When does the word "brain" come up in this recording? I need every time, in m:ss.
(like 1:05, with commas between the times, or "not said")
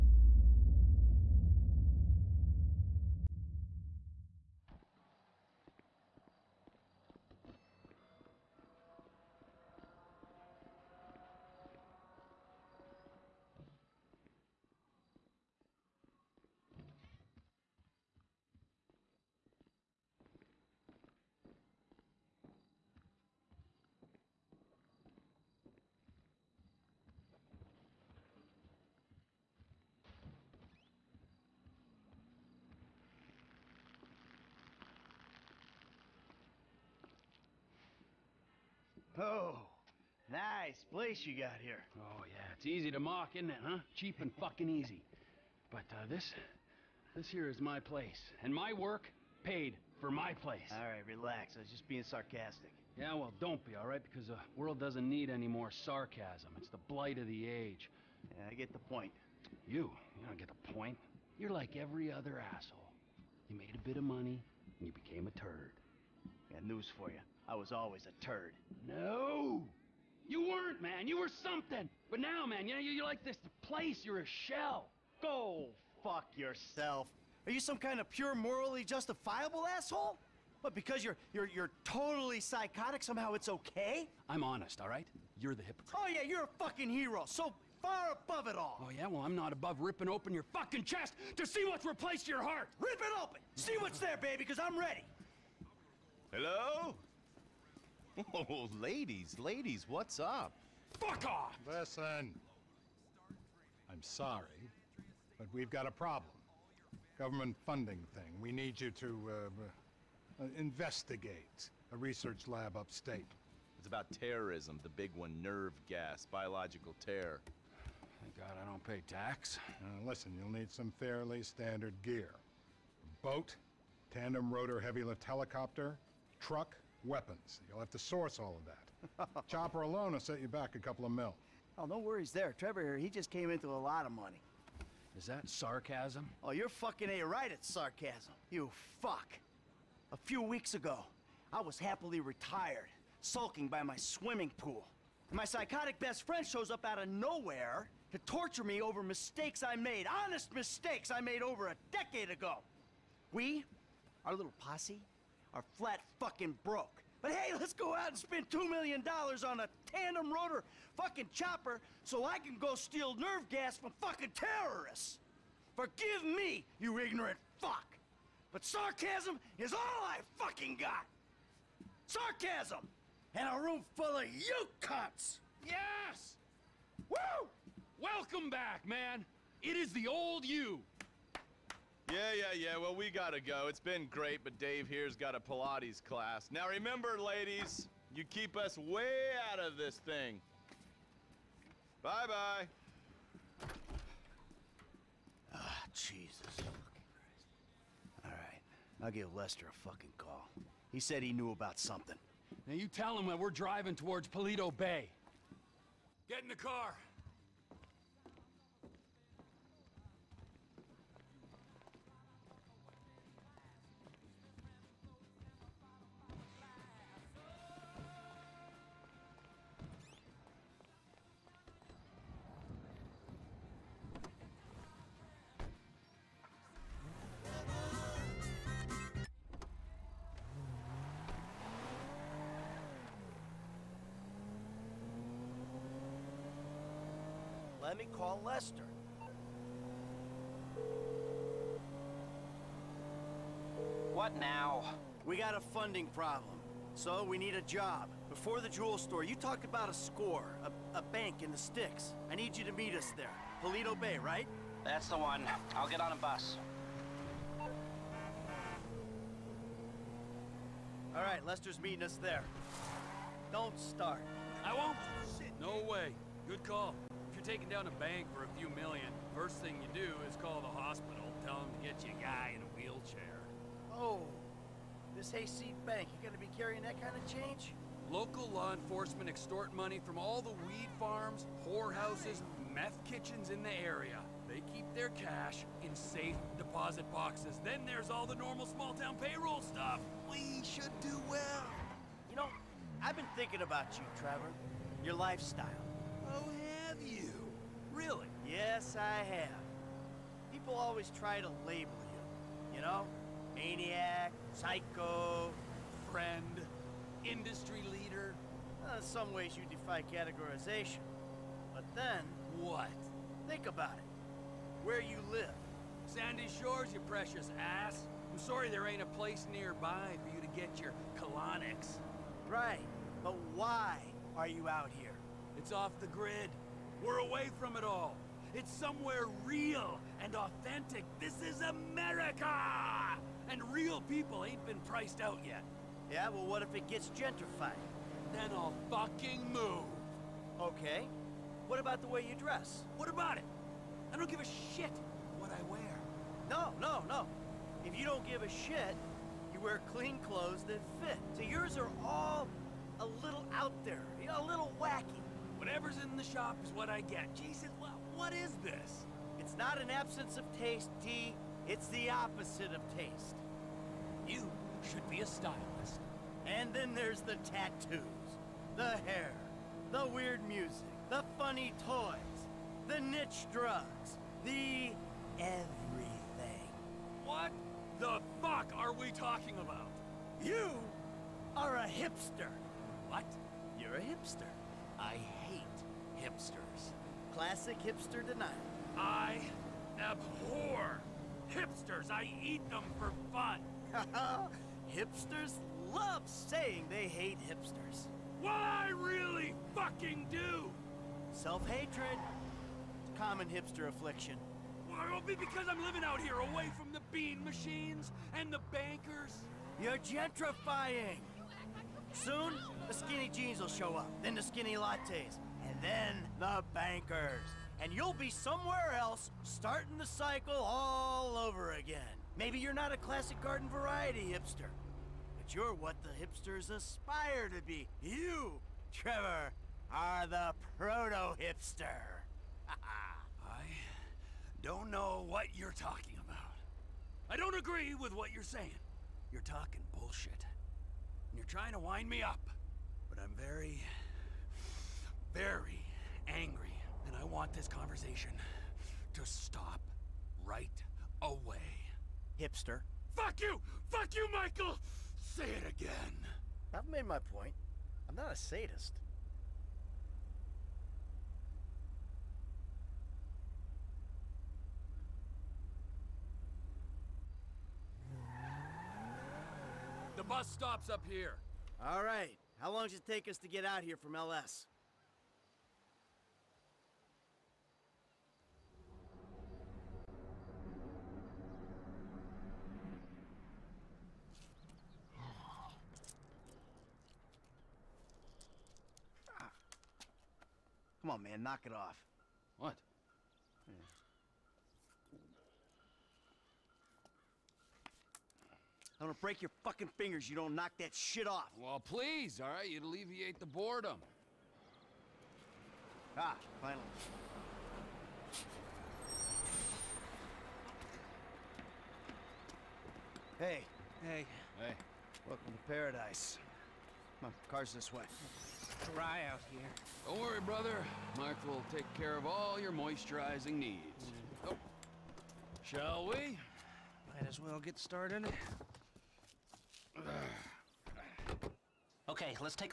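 not said.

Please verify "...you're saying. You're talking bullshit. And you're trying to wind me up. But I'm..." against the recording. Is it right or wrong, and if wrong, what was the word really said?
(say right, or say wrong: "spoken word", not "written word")
right.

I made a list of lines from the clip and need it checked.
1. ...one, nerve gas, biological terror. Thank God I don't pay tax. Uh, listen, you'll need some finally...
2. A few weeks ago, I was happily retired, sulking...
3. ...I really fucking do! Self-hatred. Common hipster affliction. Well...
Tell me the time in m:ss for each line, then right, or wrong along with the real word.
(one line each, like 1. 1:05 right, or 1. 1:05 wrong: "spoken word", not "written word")
1. 1:55 wrong: "fairly", not "finally"
2. 2:20 right
3. 6:38 right.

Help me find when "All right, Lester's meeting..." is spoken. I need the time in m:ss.
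4:21.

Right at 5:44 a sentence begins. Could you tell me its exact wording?
I don't give a shit what I wear.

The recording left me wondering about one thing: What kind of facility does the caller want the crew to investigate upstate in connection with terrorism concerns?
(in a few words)
Research lab.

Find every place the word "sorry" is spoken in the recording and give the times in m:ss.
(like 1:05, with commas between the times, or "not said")
1:44, 5:18.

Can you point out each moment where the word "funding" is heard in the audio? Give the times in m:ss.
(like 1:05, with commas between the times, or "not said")
1:47, 4:05.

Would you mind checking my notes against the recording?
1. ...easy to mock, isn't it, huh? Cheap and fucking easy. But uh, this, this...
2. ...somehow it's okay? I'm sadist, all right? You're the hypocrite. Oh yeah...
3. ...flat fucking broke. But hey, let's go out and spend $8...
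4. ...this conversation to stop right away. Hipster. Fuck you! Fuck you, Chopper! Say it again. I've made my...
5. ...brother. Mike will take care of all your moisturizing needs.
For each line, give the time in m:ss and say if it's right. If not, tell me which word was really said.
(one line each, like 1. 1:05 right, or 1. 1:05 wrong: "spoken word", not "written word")
1. 0:42 right
2. 1:23 wrong: "honest", not "sadist"
3. 2:35 wrong: "2", not "8"
4. 7:27 wrong: "Michael", not "Chopper"
5. 8:40 right.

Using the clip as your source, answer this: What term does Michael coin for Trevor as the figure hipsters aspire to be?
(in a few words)
Proto-hipster.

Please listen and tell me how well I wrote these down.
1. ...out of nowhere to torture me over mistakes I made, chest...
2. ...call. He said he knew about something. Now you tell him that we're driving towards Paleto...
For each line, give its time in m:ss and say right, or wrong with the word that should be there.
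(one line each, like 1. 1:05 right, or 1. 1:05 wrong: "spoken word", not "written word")
1. 2:26 wrong: "honest", not "chest"
2. 3:20 right.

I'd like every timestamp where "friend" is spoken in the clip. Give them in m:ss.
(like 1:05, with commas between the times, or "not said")
2:26, 5:06.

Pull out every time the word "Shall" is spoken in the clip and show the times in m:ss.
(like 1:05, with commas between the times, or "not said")
8:45.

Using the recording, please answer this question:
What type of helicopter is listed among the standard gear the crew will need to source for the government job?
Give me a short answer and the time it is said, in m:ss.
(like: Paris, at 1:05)
Tandem rotor heavy lift helicopter, at 2:04.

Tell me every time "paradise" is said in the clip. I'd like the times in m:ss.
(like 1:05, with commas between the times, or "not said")
8:35.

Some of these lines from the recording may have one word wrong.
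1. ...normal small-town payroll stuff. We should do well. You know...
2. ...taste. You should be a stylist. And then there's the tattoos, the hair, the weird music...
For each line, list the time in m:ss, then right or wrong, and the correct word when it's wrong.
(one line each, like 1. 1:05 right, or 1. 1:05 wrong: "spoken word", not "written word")
1. 4:48 right
2. 6:02 right.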